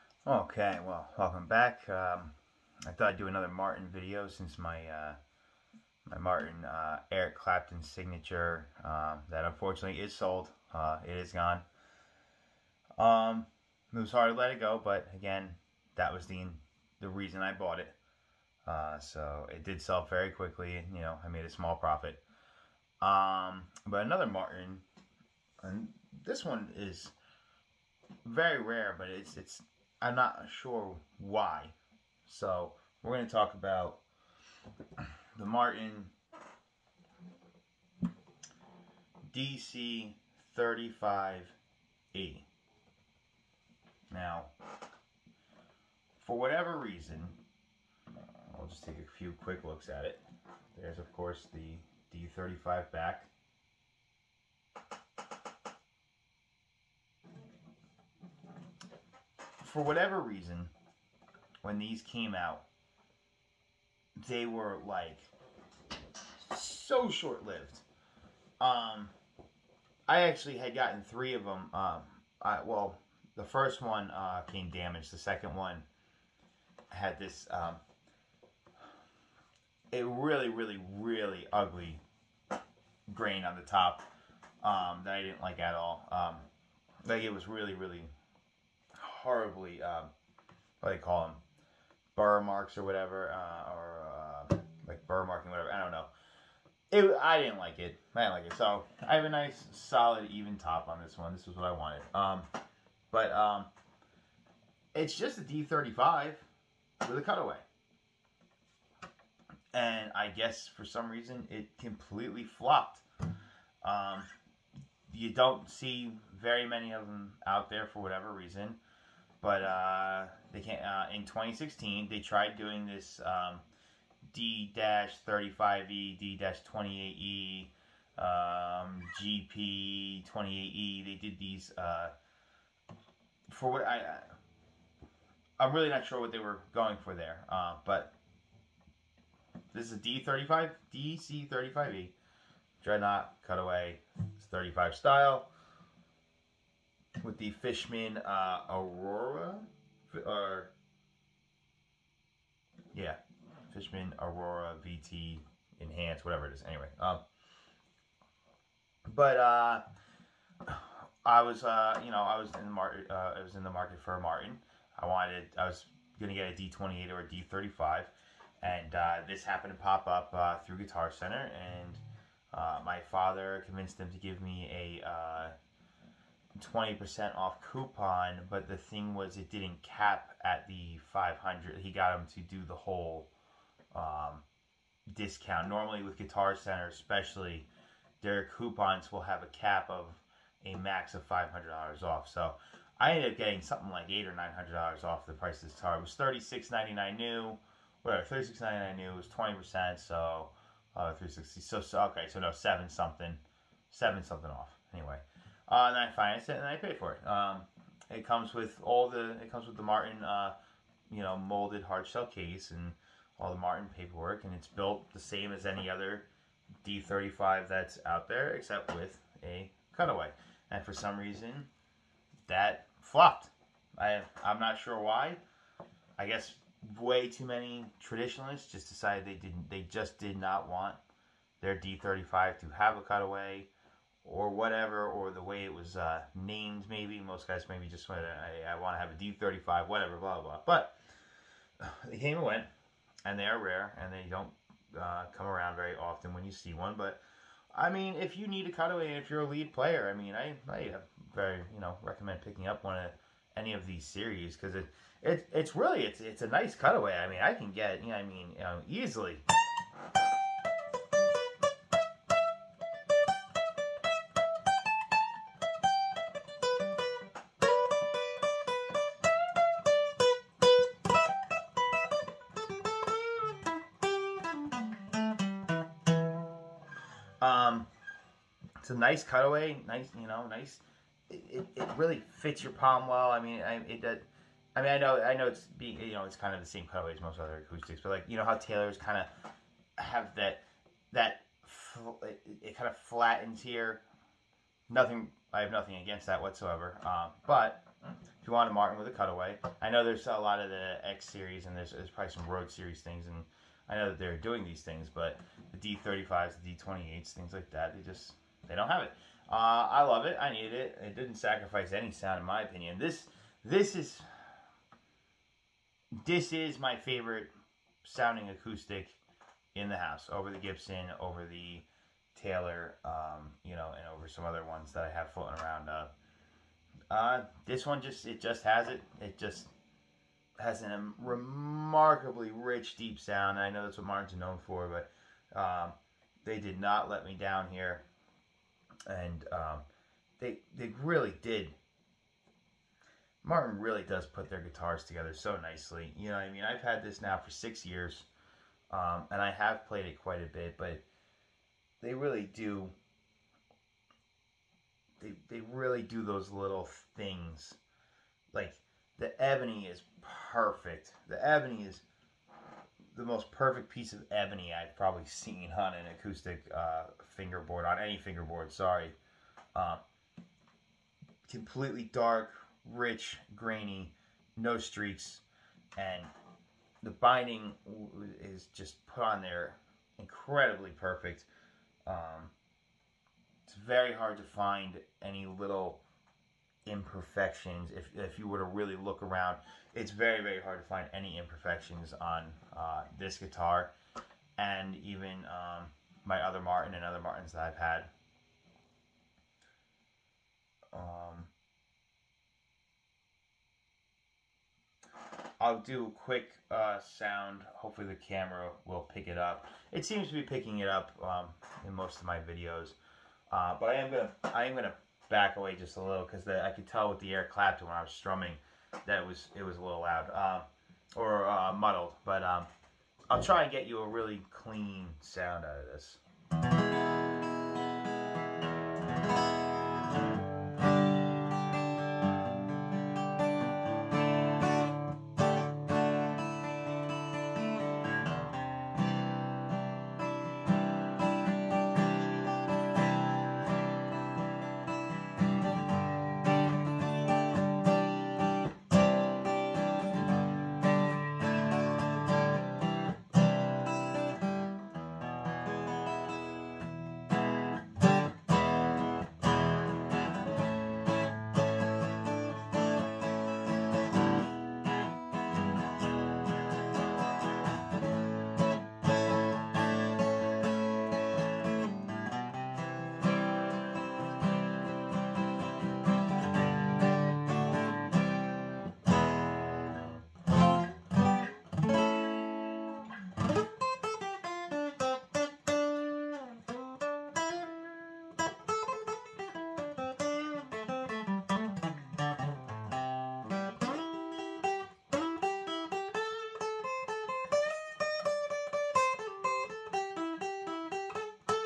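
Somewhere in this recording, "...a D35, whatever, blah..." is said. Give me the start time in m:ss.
3:59.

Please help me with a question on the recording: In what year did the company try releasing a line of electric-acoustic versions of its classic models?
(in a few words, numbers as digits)
2016.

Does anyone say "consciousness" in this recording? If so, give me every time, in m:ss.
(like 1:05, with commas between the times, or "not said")
not said.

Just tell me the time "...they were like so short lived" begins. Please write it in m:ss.
1:04.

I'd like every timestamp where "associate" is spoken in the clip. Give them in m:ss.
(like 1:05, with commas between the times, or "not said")
not said.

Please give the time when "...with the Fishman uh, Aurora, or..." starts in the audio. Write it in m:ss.
2:27.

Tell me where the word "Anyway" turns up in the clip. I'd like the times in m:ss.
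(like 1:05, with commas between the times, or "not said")
2:36, 3:24.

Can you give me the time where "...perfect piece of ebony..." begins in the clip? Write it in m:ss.
6:03.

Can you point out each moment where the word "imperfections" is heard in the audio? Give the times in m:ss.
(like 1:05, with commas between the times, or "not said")
6:26, 6:31.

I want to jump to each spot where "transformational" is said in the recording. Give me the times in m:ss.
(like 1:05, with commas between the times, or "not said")
not said.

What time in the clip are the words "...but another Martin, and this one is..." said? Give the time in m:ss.
0:23.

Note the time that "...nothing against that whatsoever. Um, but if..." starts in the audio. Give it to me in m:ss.
4:55.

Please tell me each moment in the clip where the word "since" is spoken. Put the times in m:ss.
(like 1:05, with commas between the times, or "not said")
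0:04.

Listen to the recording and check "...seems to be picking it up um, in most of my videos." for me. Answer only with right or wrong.
right.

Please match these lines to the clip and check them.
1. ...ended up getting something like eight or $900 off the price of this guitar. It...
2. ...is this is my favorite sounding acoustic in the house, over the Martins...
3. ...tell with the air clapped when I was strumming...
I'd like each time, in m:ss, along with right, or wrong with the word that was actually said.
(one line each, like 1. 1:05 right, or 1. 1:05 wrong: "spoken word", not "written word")
1. 3:13 right
2. 5:13 wrong: "Gibson", not "Martins"
3. 6:56 right.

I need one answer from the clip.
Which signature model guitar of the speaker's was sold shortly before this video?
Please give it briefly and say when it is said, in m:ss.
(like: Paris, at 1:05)
Eric Clapton, at 0:07.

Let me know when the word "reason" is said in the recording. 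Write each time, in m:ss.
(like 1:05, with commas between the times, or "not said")
0:17, 0:46, 1:00, 1:51, 1:58, 3:41.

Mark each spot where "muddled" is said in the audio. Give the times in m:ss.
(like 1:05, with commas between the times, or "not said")
7:01.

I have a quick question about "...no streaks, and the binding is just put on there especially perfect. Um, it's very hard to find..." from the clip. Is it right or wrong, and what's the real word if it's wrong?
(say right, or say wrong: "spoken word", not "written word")
wrong: "incredibly", not "especially".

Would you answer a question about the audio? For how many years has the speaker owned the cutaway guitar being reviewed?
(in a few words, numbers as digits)
6.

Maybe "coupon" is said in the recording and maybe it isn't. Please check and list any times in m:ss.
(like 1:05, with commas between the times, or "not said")
2:57, 3:08.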